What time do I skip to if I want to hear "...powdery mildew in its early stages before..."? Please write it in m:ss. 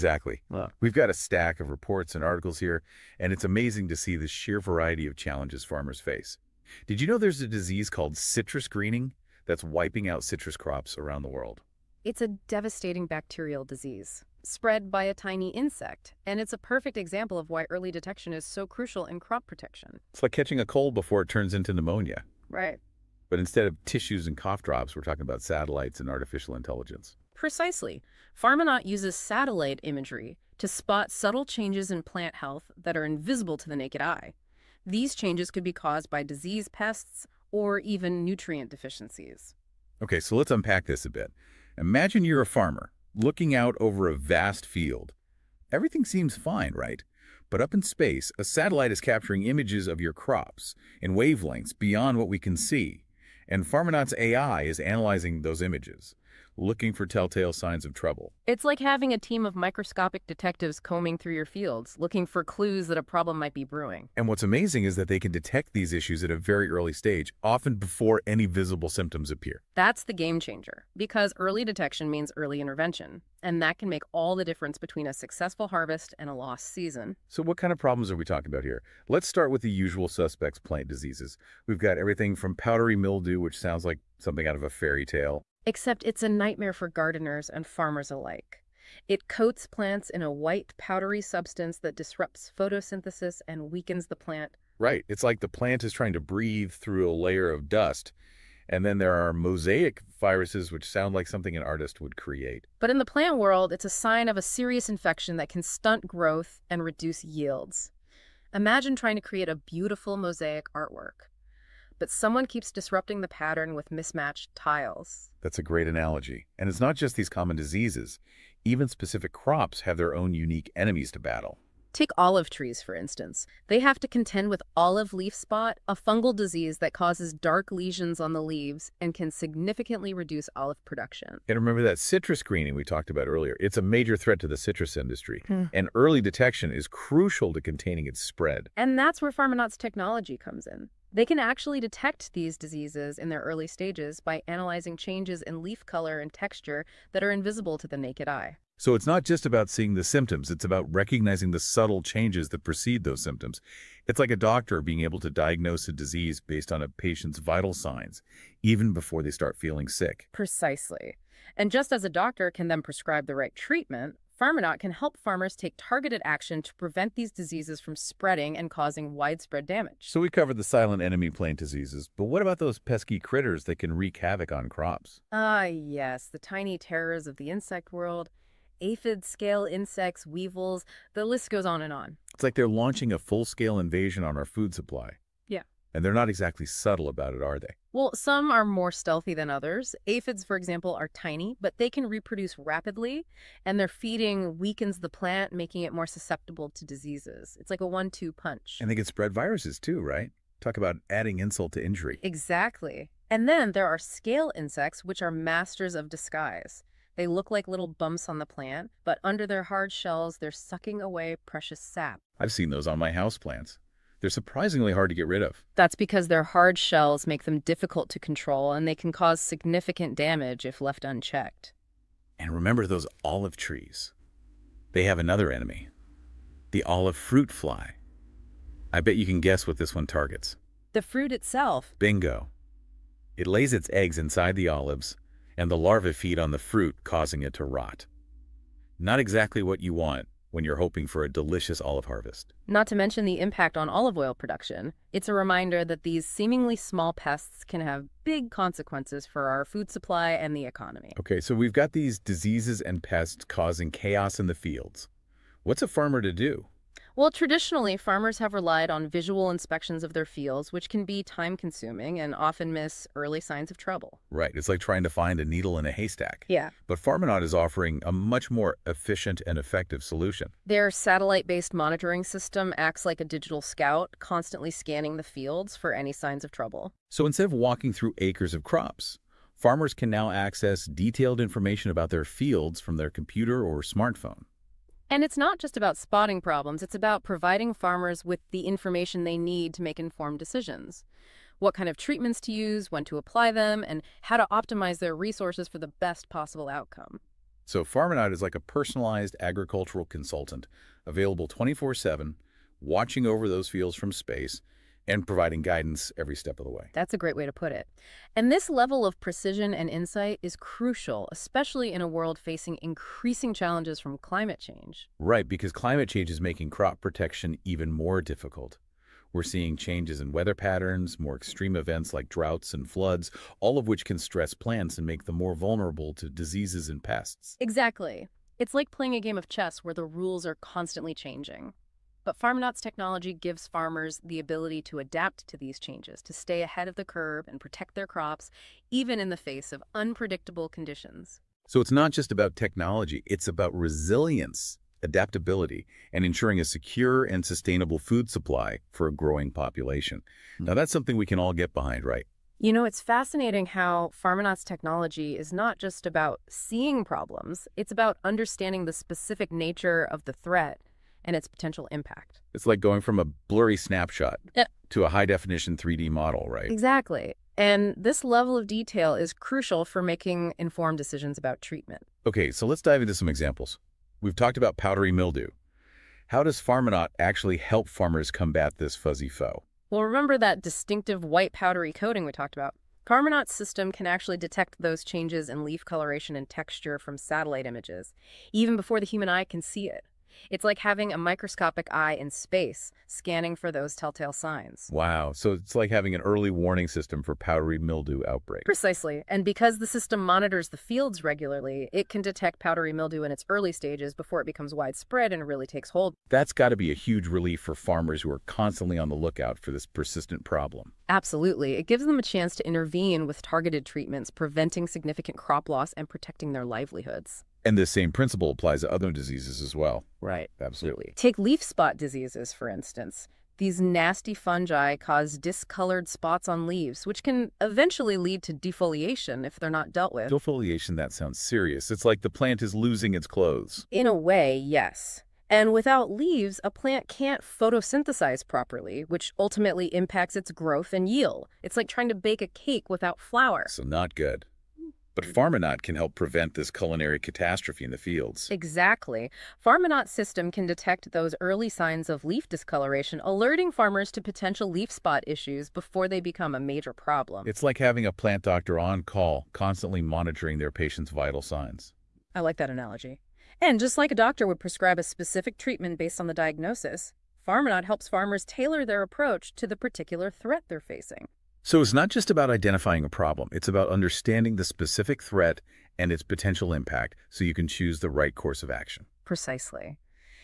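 6:42.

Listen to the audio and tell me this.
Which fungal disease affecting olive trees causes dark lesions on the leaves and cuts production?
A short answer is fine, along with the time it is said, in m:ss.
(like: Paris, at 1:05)
olive leaf spot, at 2:04.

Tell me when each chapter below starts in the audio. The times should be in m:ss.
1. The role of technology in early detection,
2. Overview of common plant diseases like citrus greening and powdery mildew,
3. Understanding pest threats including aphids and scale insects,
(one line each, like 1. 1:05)
1. 0:27
2. 1:57
3. 4:27.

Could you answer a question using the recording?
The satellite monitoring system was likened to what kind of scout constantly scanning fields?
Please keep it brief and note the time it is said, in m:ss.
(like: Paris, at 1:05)
digital scout, at 4:33.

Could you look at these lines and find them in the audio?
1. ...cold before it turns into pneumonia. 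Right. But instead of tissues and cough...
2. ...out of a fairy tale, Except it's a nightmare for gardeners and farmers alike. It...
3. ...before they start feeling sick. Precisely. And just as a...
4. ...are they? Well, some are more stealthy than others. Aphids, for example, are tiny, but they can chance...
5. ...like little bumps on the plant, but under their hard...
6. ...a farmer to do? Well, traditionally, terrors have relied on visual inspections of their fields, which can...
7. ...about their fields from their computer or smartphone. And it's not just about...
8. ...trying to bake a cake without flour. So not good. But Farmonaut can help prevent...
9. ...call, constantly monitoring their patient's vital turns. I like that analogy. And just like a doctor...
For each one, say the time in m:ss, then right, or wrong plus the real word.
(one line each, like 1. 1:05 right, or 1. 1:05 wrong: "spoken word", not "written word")
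1. 0:20 right
2. 1:24 right
3. 2:38 right
4. 3:07 wrong: "reproduce", not "chance"
5. 3:27 right
6. 4:15 wrong: "farmers", not "terrors"
7. 4:41 right
8. 7:21 right
9. 7:39 wrong: "signs", not "turns".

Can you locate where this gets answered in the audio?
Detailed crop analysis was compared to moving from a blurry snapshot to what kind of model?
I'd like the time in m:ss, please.
6:05.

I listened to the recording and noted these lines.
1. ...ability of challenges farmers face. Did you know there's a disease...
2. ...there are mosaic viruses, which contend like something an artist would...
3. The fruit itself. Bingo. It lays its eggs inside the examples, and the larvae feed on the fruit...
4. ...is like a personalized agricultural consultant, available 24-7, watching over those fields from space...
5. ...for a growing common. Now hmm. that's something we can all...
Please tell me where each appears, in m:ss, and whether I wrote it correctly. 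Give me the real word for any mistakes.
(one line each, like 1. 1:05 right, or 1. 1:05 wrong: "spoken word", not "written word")
1. 0:04 wrong: "variety", not "ability"
2. 1:38 wrong: "sound", not "contend"
3. 3:50 wrong: "olives", not "examples"
4. 4:58 right
5. 5:48 wrong: "population", not "common".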